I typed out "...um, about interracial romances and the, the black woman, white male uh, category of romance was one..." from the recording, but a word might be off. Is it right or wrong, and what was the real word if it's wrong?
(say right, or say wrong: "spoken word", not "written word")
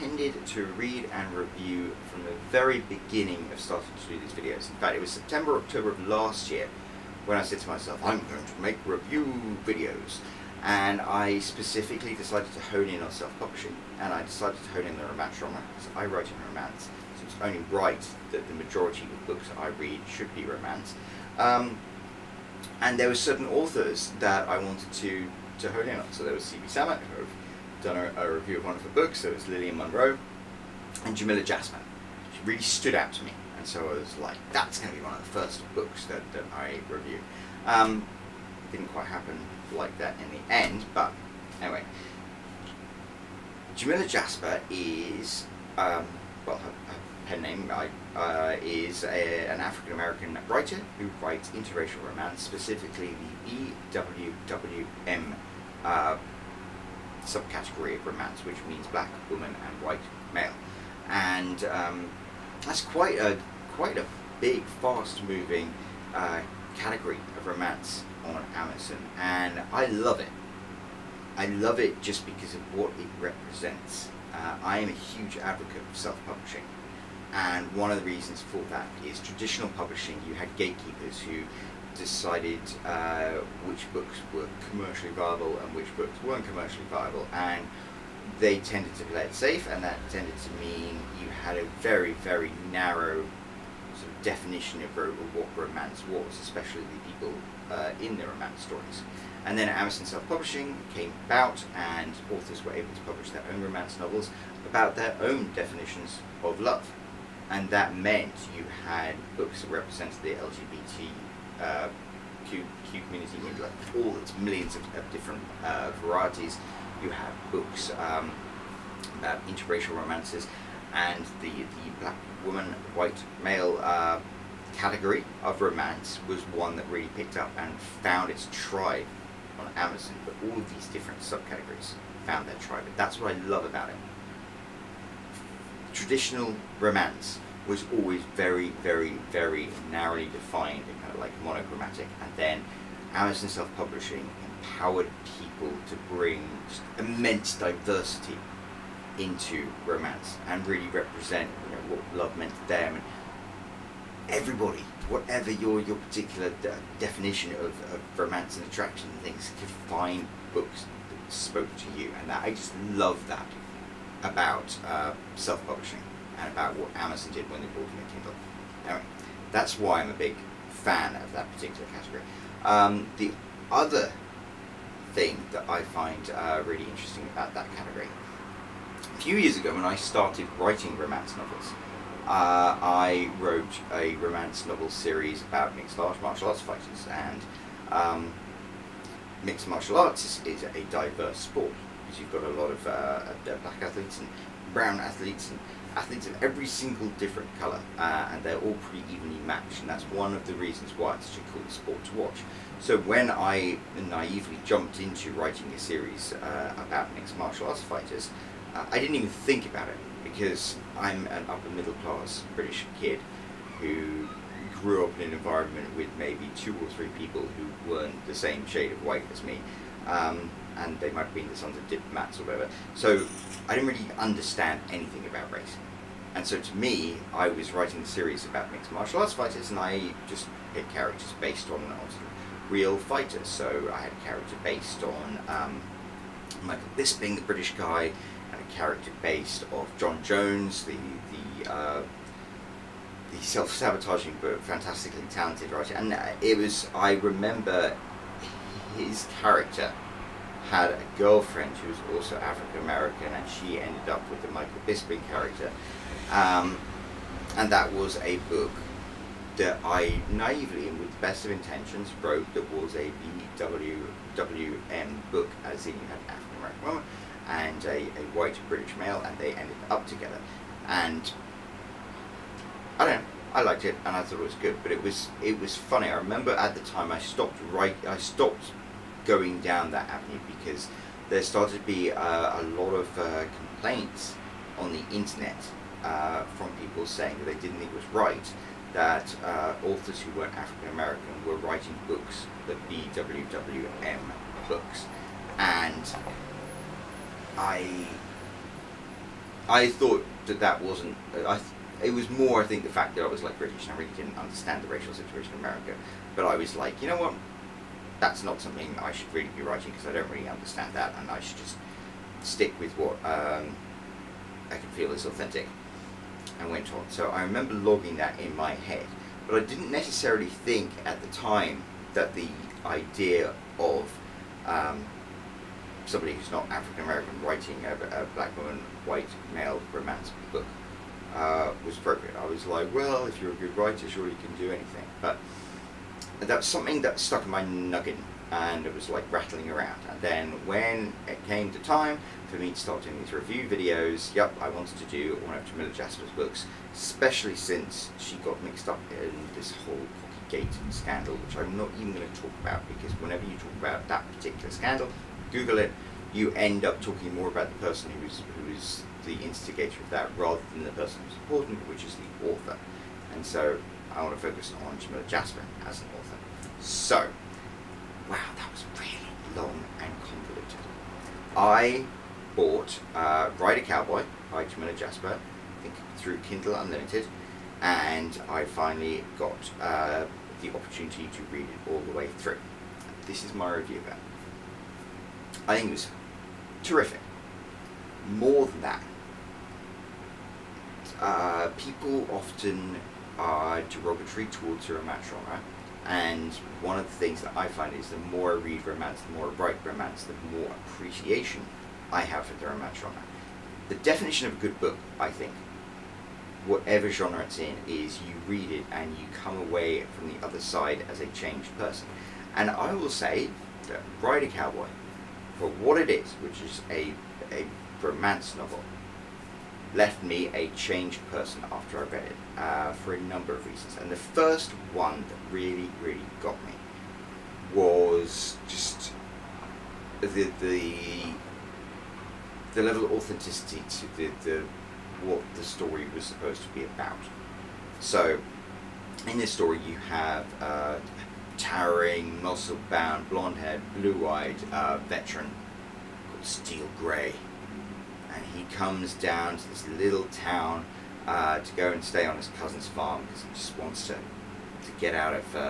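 right.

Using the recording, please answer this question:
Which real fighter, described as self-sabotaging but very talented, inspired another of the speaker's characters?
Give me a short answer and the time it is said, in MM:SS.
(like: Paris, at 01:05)
Jon Jones, at 03:59.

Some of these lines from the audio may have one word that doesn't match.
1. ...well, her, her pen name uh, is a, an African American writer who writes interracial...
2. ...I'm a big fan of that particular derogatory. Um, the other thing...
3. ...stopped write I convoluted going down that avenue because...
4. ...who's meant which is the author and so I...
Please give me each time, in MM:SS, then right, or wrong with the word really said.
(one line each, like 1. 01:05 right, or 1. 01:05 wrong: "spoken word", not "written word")
1. 00:46 right
2. 02:50 wrong: "category", not "derogatory"
3. 04:37 wrong: "stopped", not "convoluted"
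4. 06:01 wrong: "important", not "meant".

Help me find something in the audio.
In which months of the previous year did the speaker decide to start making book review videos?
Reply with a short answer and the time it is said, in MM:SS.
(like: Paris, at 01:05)
September, October, at 00:05.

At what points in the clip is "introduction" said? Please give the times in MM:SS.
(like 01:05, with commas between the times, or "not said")
not said.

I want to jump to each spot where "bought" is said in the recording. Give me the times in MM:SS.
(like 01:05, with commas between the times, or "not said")
06:12.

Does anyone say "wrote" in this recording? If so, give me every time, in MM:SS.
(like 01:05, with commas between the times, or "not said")
03:03, 04:22.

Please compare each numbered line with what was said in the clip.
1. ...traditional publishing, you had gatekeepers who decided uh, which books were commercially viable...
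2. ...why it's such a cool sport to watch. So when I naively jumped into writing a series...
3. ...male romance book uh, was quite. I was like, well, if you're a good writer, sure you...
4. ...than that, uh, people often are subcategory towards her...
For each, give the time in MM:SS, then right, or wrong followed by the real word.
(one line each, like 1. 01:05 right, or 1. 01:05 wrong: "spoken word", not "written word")
1. 01:19 right
2. 03:20 right
3. 05:29 wrong: "appropriate", not "quite"
4. 06:28 wrong: "derogatory", not "subcategory".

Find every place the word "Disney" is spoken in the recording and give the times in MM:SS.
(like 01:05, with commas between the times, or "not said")
not said.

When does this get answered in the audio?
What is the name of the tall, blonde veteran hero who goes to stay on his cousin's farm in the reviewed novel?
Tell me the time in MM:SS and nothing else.
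07:26.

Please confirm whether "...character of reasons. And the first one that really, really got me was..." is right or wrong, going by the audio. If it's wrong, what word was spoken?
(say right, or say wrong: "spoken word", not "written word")
wrong: "number", not "character".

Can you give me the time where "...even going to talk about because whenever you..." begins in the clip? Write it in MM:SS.
05:51.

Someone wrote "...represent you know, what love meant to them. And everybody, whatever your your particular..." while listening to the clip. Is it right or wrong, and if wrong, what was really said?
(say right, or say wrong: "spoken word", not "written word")
right.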